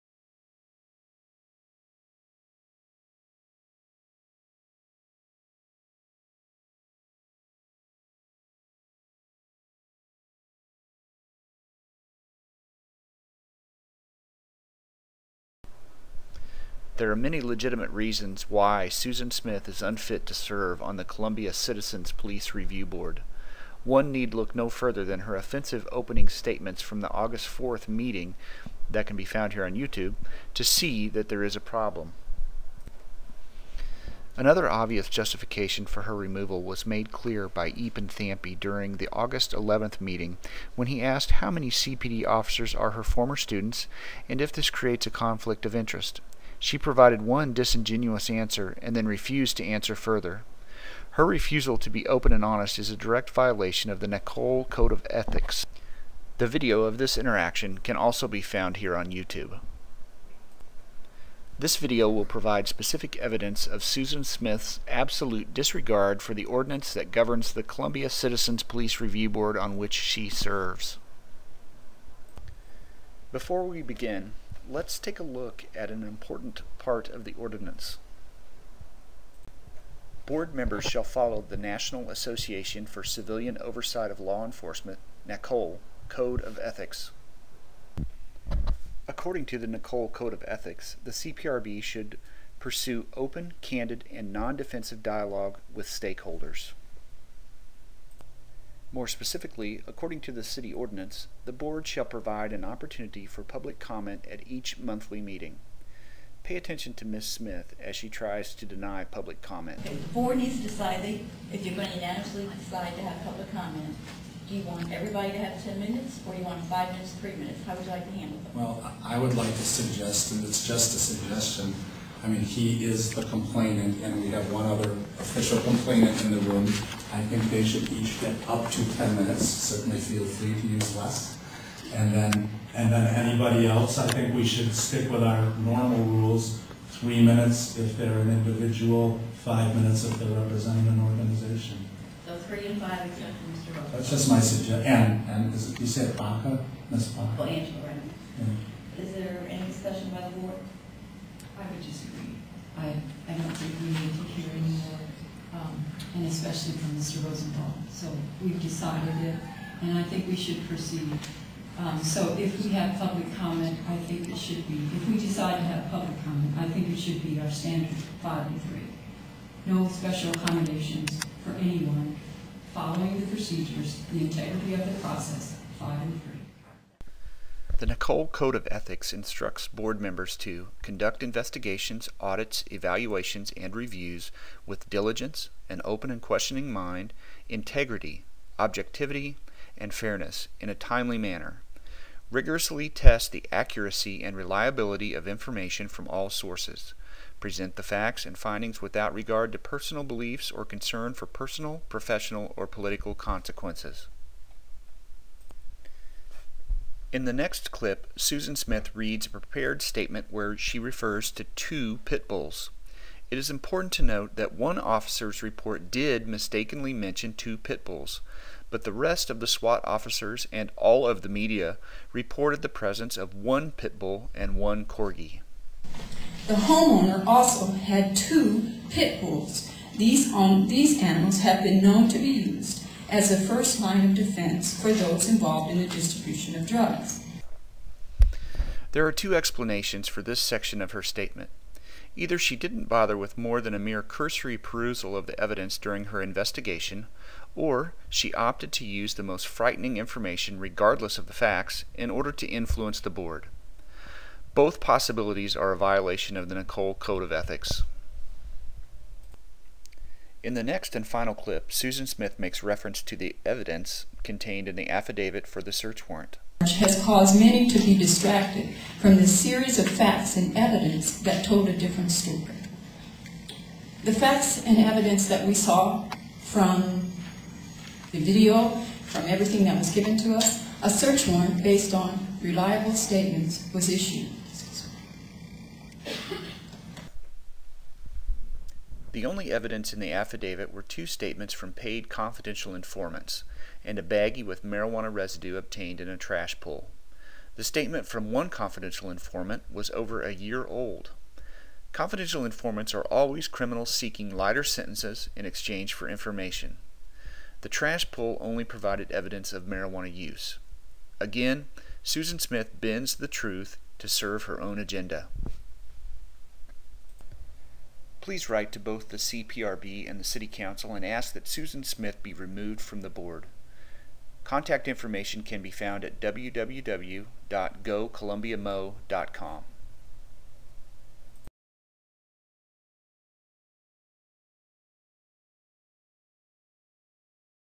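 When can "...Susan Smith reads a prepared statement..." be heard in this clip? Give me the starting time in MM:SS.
03:28.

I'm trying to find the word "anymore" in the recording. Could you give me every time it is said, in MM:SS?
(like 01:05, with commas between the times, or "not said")
02:34.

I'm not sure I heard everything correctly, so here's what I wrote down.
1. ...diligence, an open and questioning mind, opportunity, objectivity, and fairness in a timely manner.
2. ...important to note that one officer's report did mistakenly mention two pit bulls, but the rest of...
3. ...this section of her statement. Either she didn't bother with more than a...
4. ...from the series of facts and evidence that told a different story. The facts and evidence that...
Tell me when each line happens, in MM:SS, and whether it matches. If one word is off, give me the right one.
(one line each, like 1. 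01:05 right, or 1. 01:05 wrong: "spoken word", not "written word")
1. 03:04 wrong: "integrity", not "opportunity"
2. 03:33 right
3. 04:00 right
4. 04:28 right.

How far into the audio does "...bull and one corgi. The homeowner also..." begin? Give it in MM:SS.
03:43.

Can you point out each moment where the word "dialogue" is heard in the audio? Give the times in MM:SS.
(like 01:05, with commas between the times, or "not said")
01:35.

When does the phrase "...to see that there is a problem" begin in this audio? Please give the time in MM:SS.
00:30.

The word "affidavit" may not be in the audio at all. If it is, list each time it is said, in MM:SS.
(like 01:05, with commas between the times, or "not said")
04:24, 04:50.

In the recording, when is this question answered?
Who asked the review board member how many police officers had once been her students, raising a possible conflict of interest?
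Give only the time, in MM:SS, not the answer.
00:37.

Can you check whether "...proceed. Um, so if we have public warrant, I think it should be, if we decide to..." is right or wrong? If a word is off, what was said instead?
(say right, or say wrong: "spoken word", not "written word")
wrong: "comment", not "warrant".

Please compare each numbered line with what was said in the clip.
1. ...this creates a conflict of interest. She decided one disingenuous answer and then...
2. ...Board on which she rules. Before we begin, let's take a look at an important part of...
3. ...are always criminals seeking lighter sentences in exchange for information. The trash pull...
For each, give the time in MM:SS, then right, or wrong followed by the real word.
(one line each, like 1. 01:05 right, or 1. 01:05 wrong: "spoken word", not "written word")
1. 00:44 wrong: "provided", not "decided"
2. 01:09 wrong: "serves", not "rules"
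3. 05:02 right.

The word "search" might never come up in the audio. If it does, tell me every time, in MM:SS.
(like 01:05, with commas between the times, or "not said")
04:25, 04:40.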